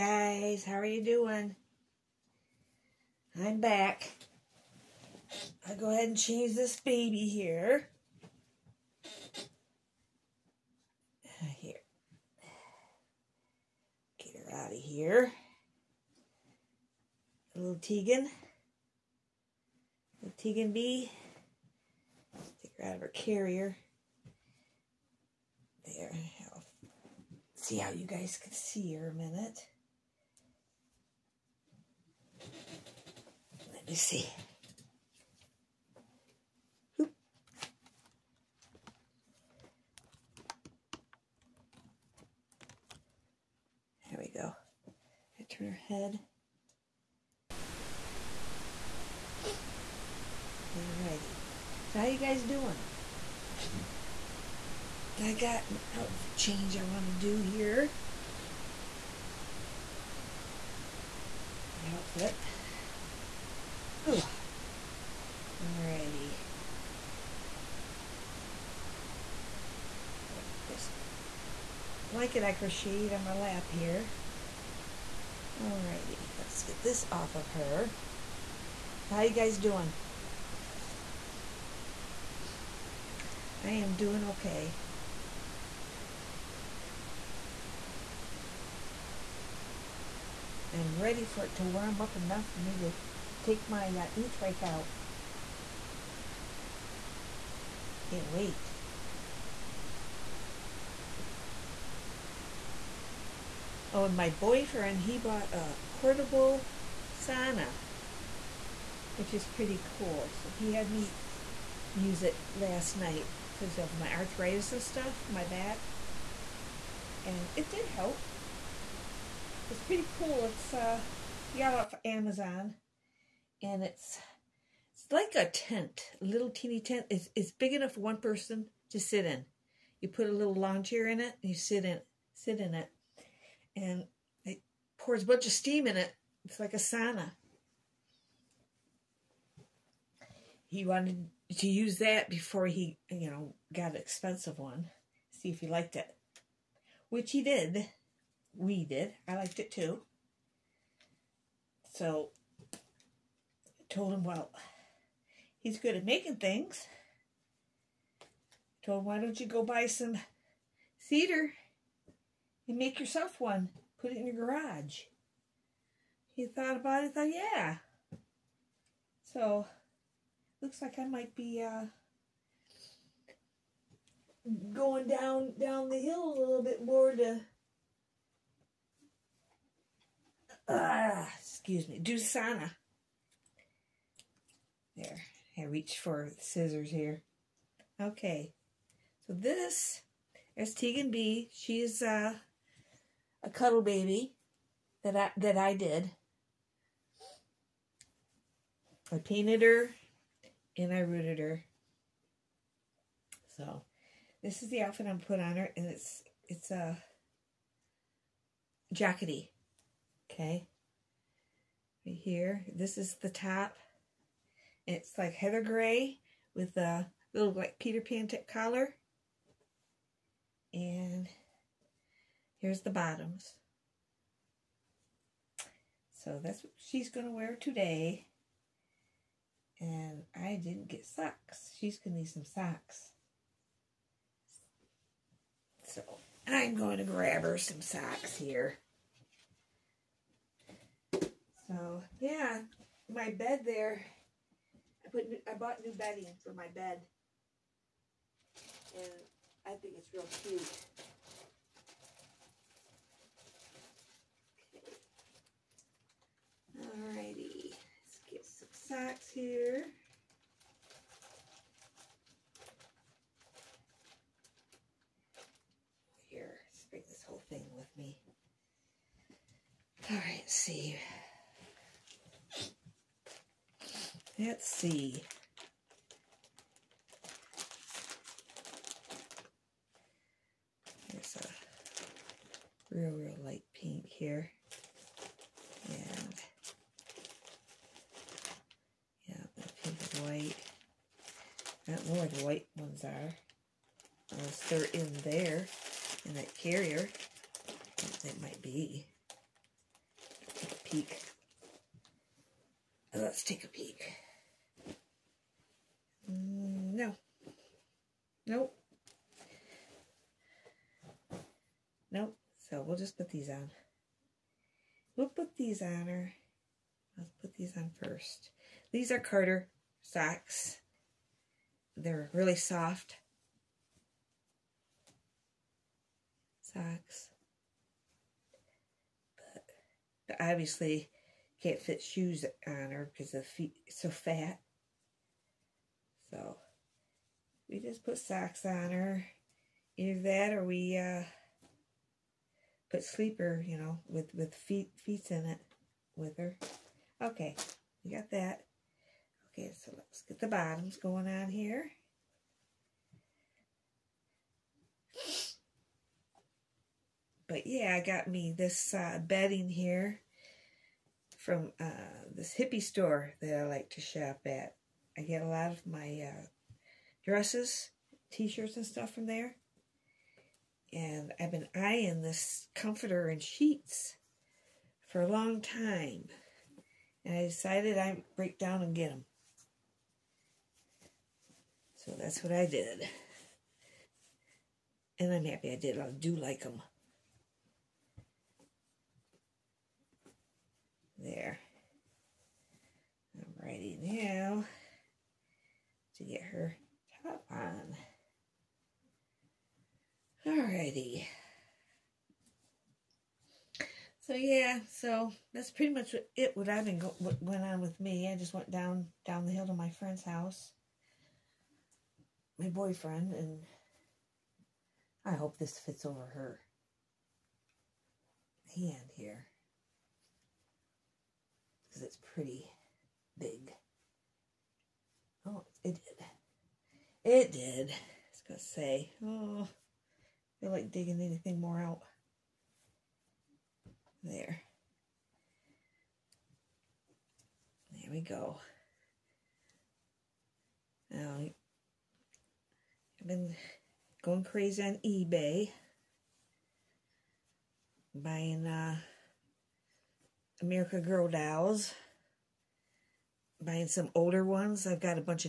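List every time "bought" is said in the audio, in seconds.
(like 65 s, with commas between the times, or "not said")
105 s, 245 s.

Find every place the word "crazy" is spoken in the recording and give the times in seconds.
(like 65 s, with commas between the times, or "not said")
444 s.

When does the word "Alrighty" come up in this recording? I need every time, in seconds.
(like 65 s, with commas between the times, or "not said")
50 s, 65 s, 75 s, 256 s, 393 s, 400 s.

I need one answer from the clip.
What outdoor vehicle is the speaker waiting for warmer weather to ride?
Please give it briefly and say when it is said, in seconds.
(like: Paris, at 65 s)
e-trike, at 94 s.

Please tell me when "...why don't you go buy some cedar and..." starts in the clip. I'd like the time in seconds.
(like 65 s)
159 s.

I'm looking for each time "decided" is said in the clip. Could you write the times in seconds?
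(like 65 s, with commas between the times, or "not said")
377 s.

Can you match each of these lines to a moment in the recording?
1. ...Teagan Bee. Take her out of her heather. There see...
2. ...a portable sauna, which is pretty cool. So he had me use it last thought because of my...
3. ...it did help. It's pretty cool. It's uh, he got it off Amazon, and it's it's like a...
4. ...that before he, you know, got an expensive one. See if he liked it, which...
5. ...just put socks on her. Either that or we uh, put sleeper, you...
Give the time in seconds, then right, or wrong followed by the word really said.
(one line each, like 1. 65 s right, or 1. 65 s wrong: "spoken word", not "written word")
1. 20 s wrong: "carrier", not "heather"
2. 105 s wrong: "night", not "thought"
3. 117 s right
4. 141 s right
5. 337 s right.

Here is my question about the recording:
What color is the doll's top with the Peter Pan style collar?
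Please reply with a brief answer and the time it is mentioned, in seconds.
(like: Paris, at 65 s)
heather gray, at 215 s.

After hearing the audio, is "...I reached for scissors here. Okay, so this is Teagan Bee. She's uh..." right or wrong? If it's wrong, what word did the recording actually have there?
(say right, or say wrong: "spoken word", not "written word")
right.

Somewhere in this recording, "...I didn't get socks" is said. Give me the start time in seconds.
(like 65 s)
230 s.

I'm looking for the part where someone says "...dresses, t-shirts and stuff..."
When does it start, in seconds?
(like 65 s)
367 s.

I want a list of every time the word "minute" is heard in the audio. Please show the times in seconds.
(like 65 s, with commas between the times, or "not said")
29 s.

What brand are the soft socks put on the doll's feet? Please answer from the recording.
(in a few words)
Carter.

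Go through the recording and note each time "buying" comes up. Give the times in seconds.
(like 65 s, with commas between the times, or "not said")
448 s, 453 s.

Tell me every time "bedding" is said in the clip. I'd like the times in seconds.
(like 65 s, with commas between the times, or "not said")
245 s, 359 s.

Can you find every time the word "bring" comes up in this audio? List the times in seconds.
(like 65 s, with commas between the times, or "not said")
266 s.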